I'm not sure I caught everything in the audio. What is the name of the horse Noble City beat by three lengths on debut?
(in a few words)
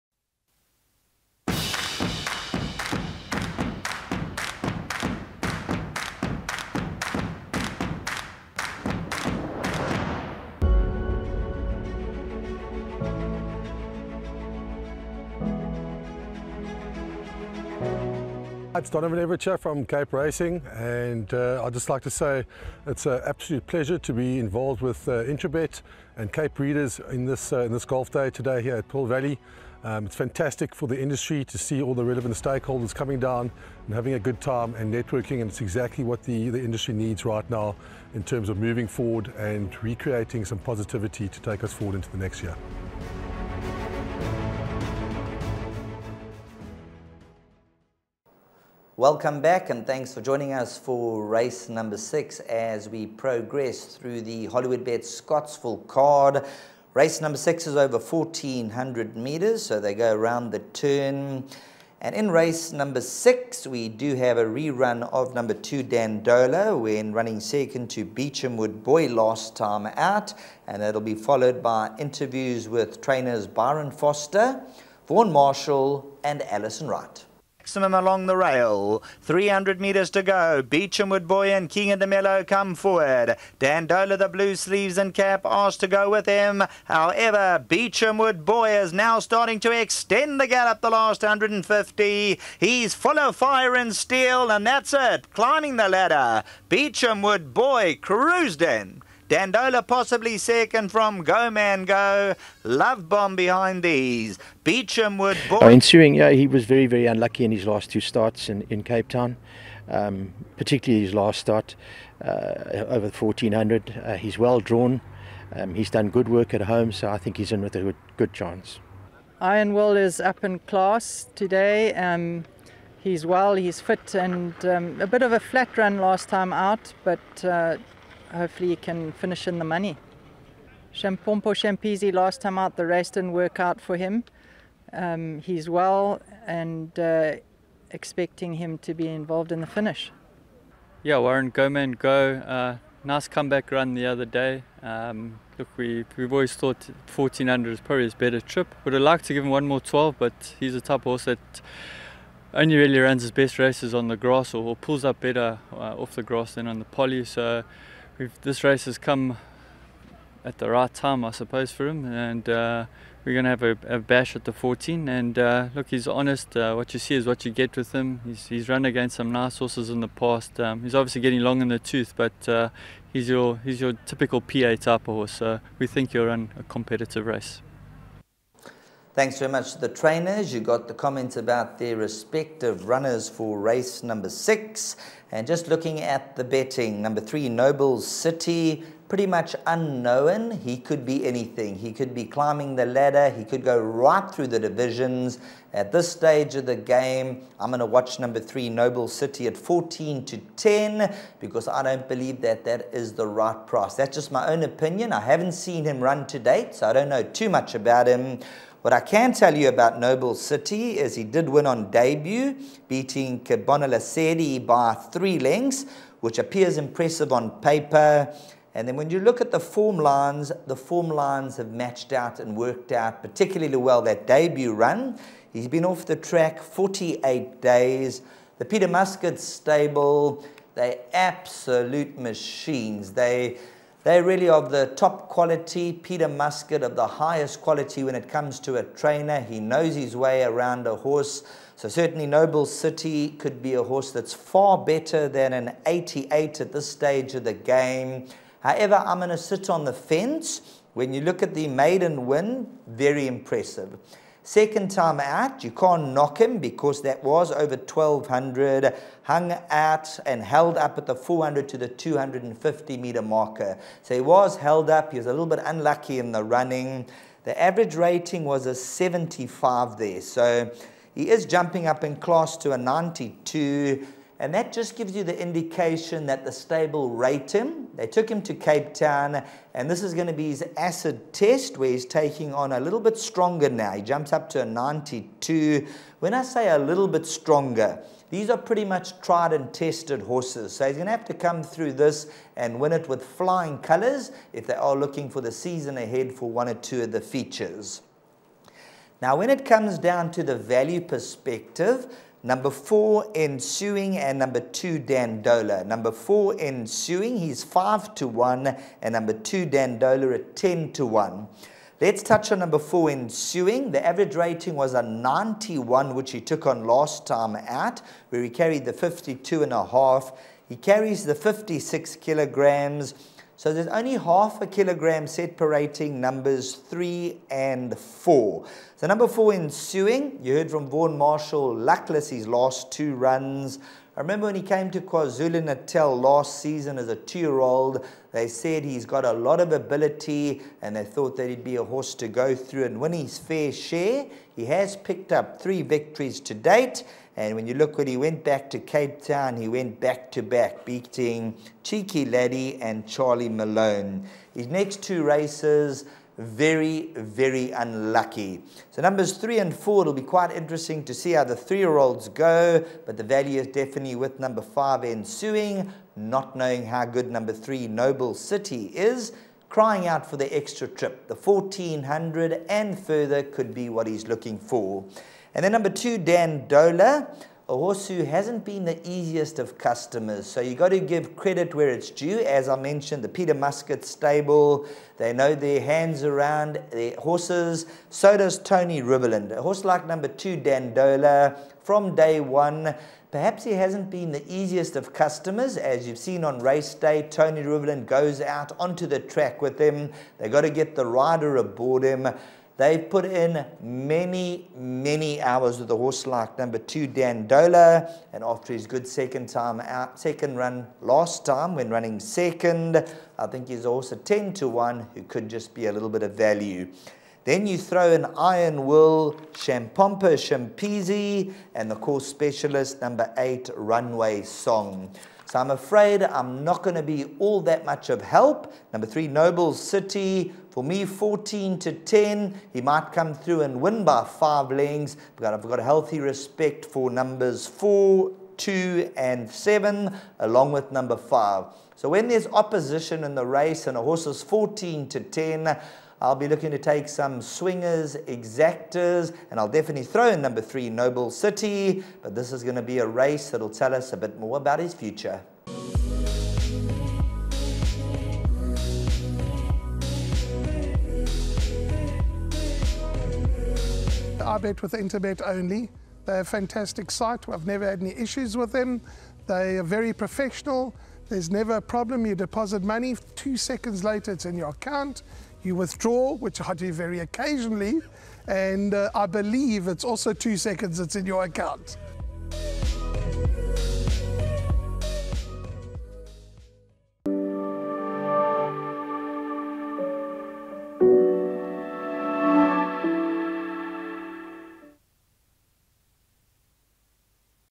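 Kebonalasedi.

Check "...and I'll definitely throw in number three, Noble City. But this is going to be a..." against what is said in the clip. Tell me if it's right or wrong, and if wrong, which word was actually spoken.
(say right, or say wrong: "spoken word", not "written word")
right.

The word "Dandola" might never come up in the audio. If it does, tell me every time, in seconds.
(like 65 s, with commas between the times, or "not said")
65 s, 83 s, 99 s, 304 s, 309 s, 376 s, 390 s, 407 s.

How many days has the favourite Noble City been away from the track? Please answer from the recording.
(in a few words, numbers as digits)
48.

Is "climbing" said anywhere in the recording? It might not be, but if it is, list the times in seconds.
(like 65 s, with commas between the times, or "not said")
95 s, 192 s.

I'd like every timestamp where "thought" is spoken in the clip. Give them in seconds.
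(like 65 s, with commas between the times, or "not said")
146 s, 341 s.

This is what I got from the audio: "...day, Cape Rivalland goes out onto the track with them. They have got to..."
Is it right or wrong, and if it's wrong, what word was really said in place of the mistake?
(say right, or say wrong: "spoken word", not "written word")
wrong: "Tony", not "Cape".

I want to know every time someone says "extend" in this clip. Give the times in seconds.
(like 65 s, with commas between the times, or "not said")
89 s.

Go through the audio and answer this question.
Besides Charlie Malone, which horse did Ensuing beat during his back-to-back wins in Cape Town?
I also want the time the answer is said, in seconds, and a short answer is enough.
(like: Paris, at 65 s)
Cheeky Laddie, at 351 s.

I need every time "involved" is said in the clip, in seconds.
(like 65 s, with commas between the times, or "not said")
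24 s, 139 s.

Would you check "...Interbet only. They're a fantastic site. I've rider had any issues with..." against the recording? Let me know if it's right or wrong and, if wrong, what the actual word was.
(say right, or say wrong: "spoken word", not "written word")
wrong: "never", not "rider".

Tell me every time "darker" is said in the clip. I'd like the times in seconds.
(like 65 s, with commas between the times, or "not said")
not said.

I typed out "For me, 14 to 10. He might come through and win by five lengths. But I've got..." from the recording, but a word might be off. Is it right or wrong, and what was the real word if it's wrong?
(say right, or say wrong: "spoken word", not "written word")
right.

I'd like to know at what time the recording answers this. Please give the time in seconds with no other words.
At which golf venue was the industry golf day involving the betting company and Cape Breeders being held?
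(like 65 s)
28 s.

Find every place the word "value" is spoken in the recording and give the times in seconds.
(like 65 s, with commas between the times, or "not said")
300 s, 363 s, 416 s.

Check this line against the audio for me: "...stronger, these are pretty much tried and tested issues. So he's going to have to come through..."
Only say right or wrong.
wrong.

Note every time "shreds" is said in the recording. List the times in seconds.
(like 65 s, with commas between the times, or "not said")
not said.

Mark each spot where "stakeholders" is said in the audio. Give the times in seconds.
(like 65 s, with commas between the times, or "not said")
32 s.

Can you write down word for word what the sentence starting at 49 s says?
Welcome back and thanks for joining us for race number six as we progress through the Hollywoodbets Scottsville card.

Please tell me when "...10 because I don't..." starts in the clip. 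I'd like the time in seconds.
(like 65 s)
200 s.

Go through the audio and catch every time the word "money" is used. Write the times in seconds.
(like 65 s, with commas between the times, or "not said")
129 s, 472 s.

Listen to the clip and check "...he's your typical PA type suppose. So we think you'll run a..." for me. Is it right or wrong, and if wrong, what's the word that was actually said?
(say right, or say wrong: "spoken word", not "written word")
wrong: "horse", not "suppose".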